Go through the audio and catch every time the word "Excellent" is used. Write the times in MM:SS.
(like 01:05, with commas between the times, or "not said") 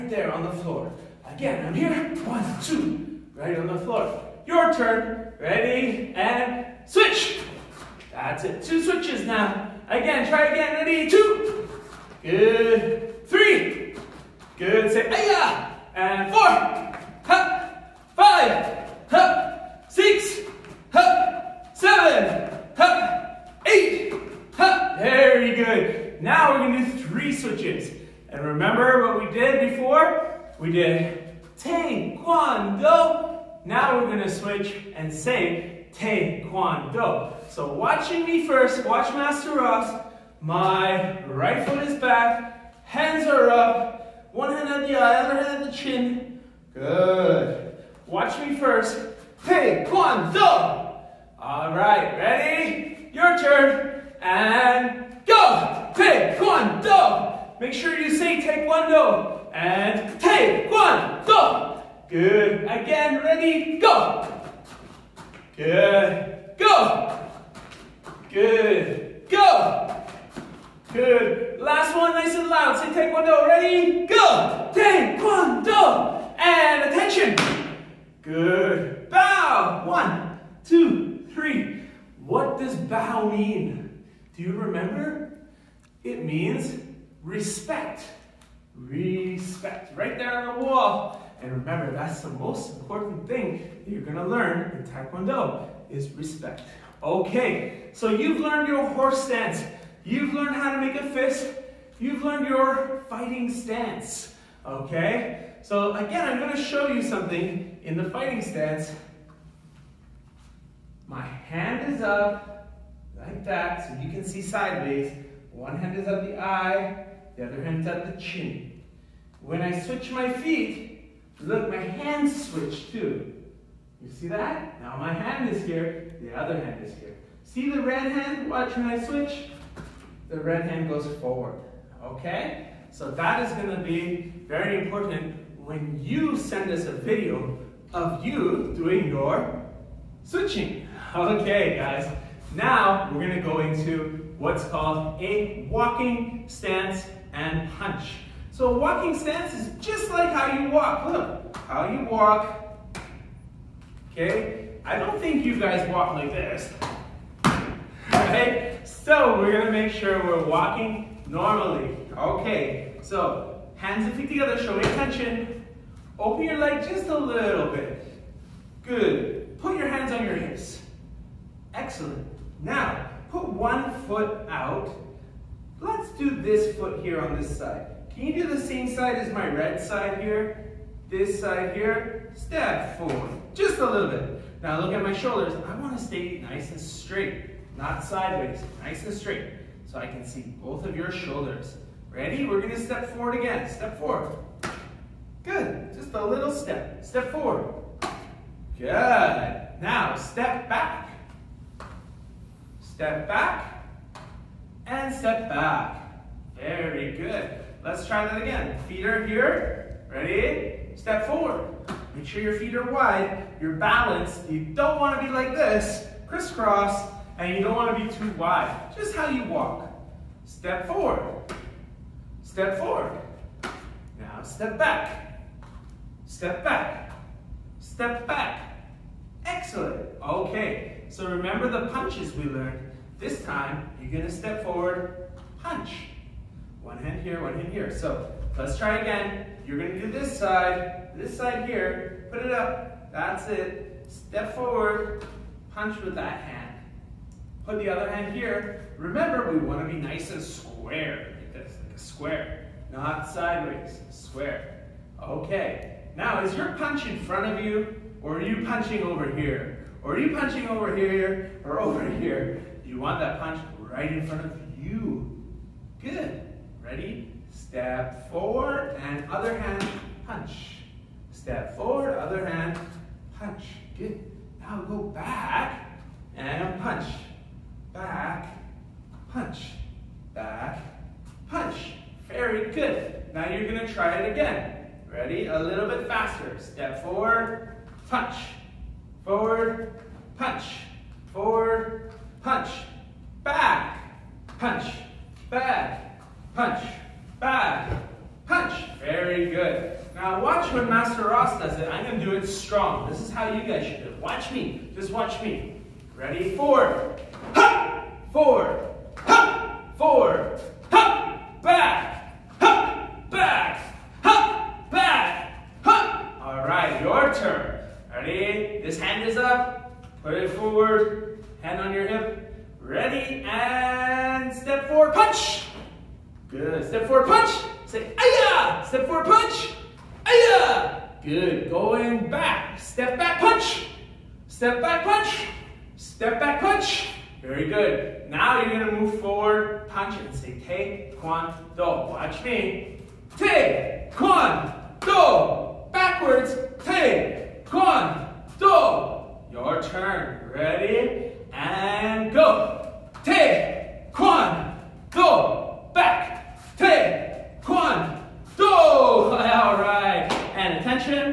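02:51, 03:49.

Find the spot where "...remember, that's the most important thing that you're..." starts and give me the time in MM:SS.
01:31.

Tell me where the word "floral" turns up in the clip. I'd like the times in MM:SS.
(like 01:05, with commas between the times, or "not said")
not said.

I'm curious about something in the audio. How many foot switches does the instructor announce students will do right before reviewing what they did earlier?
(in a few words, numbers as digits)
3.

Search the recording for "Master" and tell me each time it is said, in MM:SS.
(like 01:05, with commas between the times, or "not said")
00:39, 05:00.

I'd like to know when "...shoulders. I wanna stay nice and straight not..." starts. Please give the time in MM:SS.
03:05.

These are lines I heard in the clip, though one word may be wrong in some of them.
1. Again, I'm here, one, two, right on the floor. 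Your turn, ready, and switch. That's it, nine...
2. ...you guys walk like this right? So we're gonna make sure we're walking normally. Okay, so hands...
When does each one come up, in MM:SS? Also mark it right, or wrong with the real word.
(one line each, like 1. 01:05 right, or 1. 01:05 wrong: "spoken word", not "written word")
1. 00:01 wrong: "two", not "nine"
2. 02:35 right.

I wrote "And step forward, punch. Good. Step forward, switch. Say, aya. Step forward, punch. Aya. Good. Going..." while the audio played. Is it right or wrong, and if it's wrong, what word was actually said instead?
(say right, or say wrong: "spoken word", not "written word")
wrong: "punch", not "switch".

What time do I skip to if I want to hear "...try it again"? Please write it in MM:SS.
04:43.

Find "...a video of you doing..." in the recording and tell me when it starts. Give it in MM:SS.
02:16.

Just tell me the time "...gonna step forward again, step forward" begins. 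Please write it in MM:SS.
03:12.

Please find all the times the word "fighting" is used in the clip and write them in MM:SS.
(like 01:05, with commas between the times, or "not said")
01:43, 01:48.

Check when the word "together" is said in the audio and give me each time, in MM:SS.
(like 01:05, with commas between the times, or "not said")
02:44.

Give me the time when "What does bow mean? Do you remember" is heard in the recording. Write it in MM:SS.
01:22.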